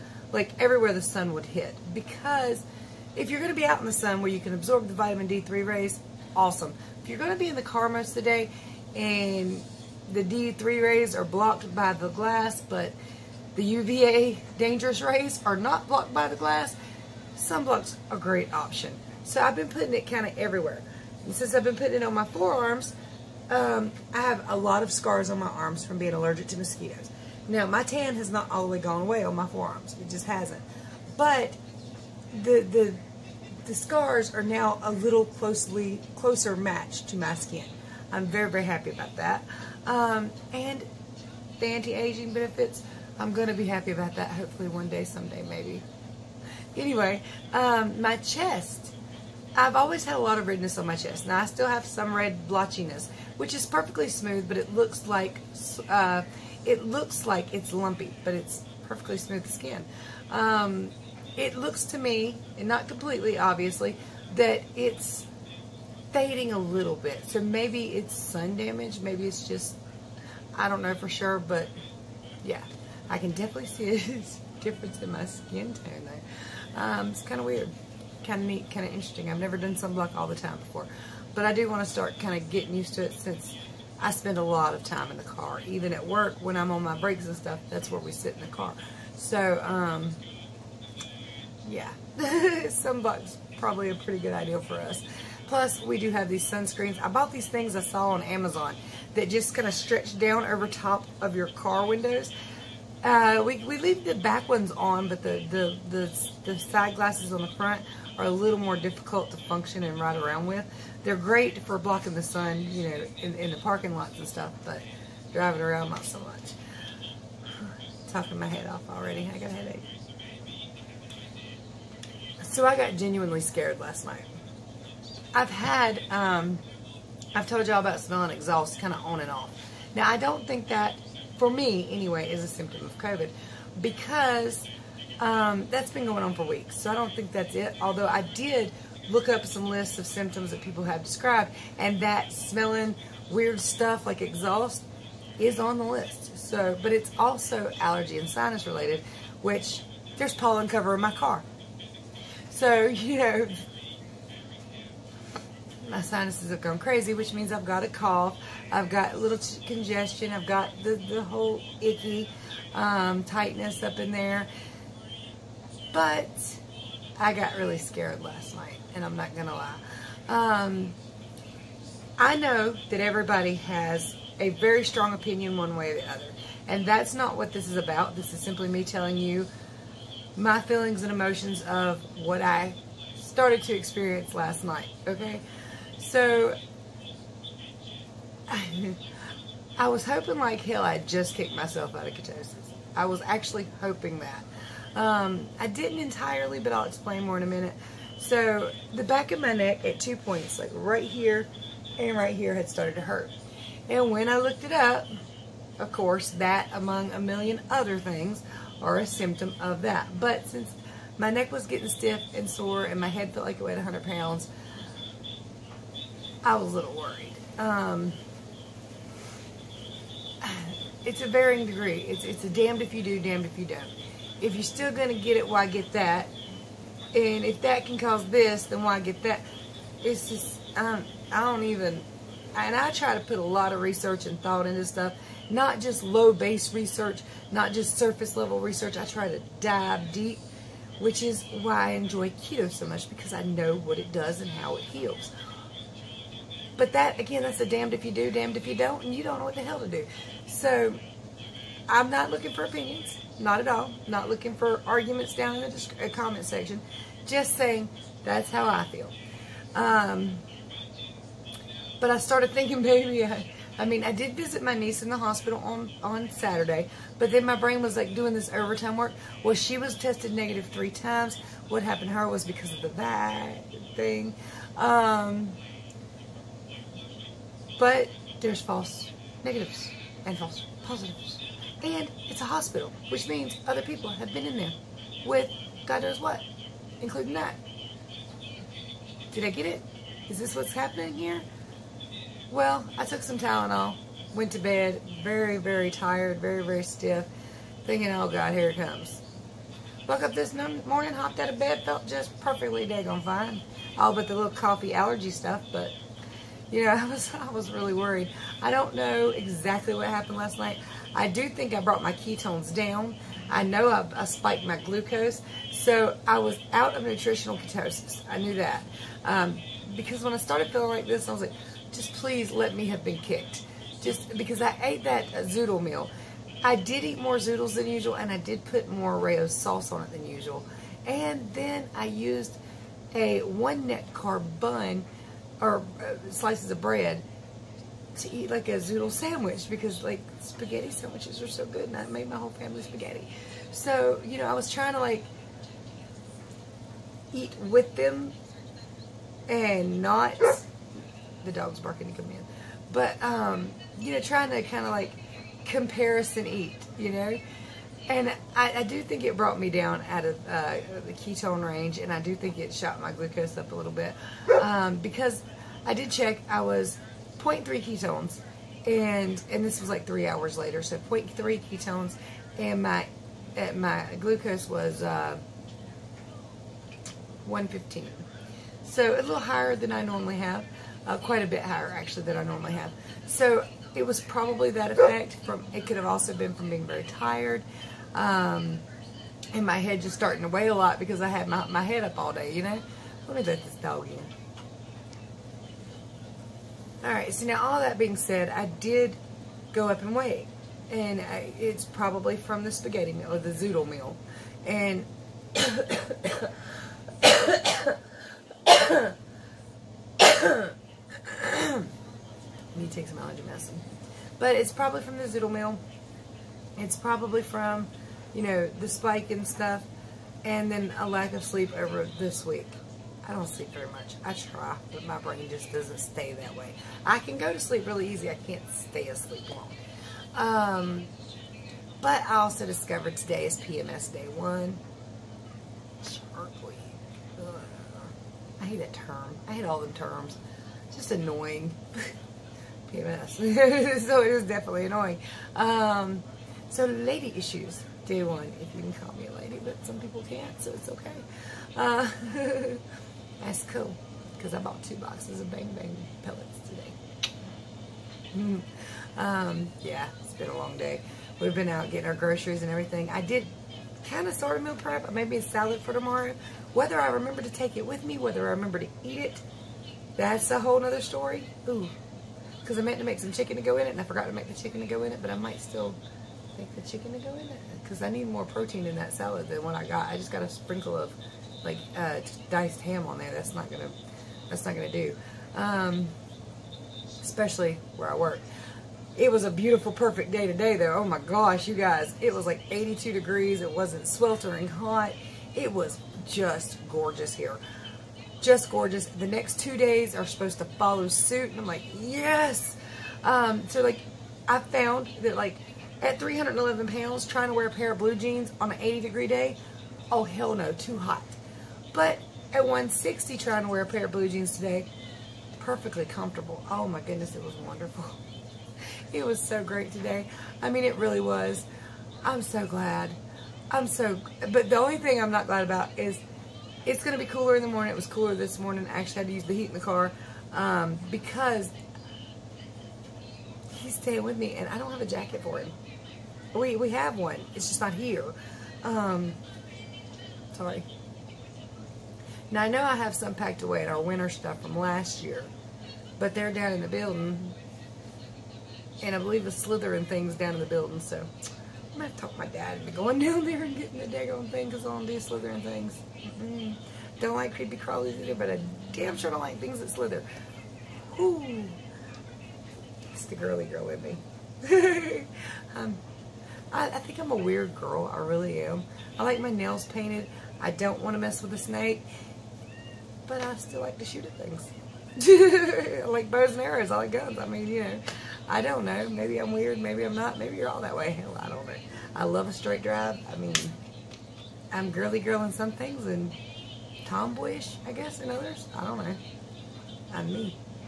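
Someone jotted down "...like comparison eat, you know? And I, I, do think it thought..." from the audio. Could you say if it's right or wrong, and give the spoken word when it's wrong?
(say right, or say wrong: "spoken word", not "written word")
wrong: "brought", not "thought".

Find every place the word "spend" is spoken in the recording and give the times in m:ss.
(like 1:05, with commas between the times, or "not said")
1:24.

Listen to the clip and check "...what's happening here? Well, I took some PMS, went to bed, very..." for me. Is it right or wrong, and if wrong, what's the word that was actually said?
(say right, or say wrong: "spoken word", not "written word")
wrong: "Tylenol", not "PMS".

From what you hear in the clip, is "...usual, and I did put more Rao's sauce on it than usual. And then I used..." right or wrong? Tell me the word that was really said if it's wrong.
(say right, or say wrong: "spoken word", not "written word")
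right.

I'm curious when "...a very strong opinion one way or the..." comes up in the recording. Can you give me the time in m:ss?
2:54.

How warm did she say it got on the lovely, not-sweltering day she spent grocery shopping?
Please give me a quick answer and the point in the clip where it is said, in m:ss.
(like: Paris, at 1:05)
82 degrees, at 8:12.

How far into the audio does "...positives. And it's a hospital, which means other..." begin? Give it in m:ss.
4:40.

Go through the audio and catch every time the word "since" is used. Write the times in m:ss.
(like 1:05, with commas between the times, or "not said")
0:21, 1:23, 3:30.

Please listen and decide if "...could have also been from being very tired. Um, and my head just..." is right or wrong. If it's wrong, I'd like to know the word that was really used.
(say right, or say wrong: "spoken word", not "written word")
right.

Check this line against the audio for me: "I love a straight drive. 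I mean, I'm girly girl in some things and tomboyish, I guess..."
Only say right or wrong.
right.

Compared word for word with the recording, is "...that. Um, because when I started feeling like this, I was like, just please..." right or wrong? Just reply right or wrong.
right.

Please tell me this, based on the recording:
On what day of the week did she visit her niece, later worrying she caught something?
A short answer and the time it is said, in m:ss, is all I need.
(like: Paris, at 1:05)
Saturday, at 4:26.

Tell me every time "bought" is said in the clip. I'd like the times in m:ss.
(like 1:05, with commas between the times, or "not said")
1:37, 7:34.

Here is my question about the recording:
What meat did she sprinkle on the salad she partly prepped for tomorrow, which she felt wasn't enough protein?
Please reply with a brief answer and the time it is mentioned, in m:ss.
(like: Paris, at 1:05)
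Diced ham, at 8:02.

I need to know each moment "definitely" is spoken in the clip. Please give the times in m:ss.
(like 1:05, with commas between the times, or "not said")
1:13, 7:24.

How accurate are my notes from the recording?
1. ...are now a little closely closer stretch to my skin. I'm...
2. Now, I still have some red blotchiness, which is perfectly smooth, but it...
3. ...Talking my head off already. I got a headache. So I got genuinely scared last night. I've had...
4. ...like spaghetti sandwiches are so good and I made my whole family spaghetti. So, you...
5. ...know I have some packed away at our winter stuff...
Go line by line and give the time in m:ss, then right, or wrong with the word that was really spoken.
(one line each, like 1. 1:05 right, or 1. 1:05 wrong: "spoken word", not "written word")
1. 0:34 wrong: "match", not "stretch"
2. 0:51 right
3. 1:58 right
4. 5:40 right
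5. 9:02 right.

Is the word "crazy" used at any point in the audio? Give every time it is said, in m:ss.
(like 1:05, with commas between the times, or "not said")
2:36.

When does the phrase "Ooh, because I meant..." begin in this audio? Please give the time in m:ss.
7:51.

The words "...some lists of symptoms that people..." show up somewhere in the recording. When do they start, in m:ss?
2:19.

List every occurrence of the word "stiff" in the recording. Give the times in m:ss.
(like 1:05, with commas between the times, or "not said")
3:31, 4:56.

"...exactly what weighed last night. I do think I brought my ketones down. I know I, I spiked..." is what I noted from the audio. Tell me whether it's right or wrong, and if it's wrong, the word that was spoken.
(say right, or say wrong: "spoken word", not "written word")
wrong: "happened", not "weighed".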